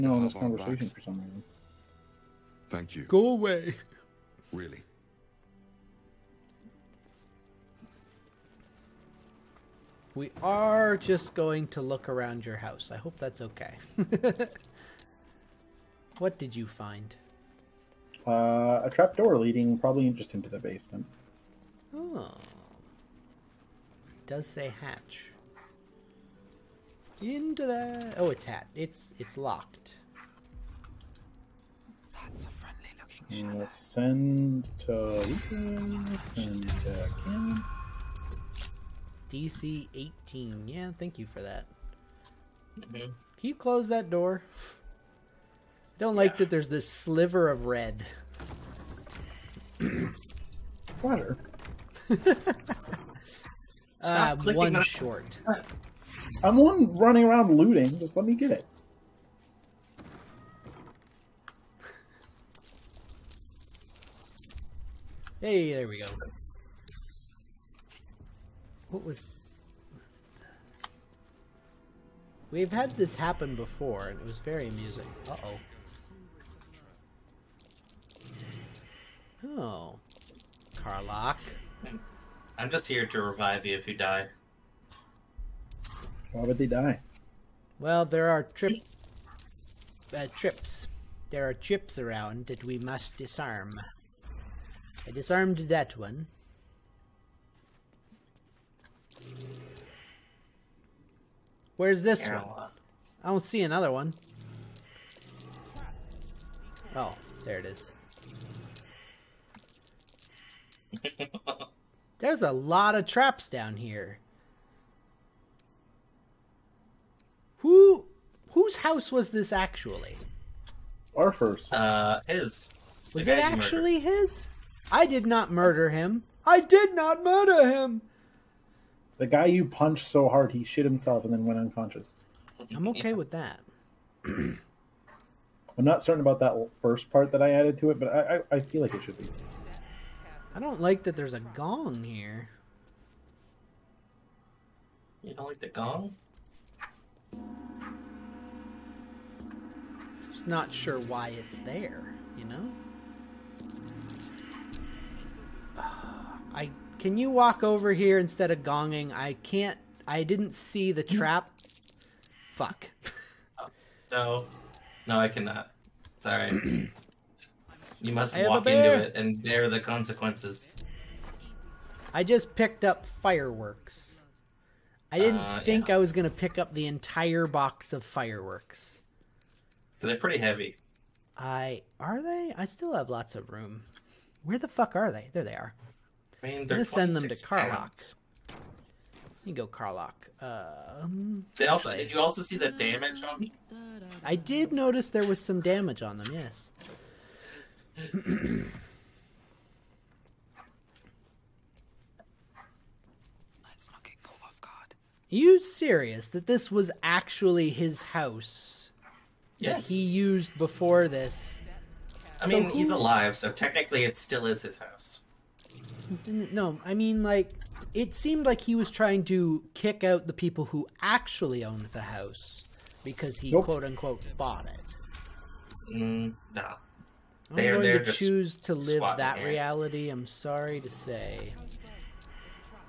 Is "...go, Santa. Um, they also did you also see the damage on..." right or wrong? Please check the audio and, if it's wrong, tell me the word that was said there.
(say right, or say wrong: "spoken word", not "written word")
wrong: "Karlach", not "Santa".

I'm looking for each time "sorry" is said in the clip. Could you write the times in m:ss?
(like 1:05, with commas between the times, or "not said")
2:46, 3:50.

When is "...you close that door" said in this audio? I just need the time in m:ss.
0:43.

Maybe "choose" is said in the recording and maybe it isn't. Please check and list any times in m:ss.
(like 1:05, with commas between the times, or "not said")
3:48.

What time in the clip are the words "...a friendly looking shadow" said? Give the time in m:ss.
0:32.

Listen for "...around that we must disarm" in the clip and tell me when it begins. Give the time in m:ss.
1:31.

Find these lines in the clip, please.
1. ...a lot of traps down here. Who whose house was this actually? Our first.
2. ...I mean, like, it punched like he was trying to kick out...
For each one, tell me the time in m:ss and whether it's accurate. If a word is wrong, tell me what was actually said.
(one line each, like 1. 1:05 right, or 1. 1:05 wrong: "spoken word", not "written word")
1. 1:52 right
2. 3:36 wrong: "seemed", not "punched".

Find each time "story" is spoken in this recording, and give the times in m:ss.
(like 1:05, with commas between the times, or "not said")
not said.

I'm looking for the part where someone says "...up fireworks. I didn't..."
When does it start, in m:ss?
2:52.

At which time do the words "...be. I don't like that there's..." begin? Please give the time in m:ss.
2:19.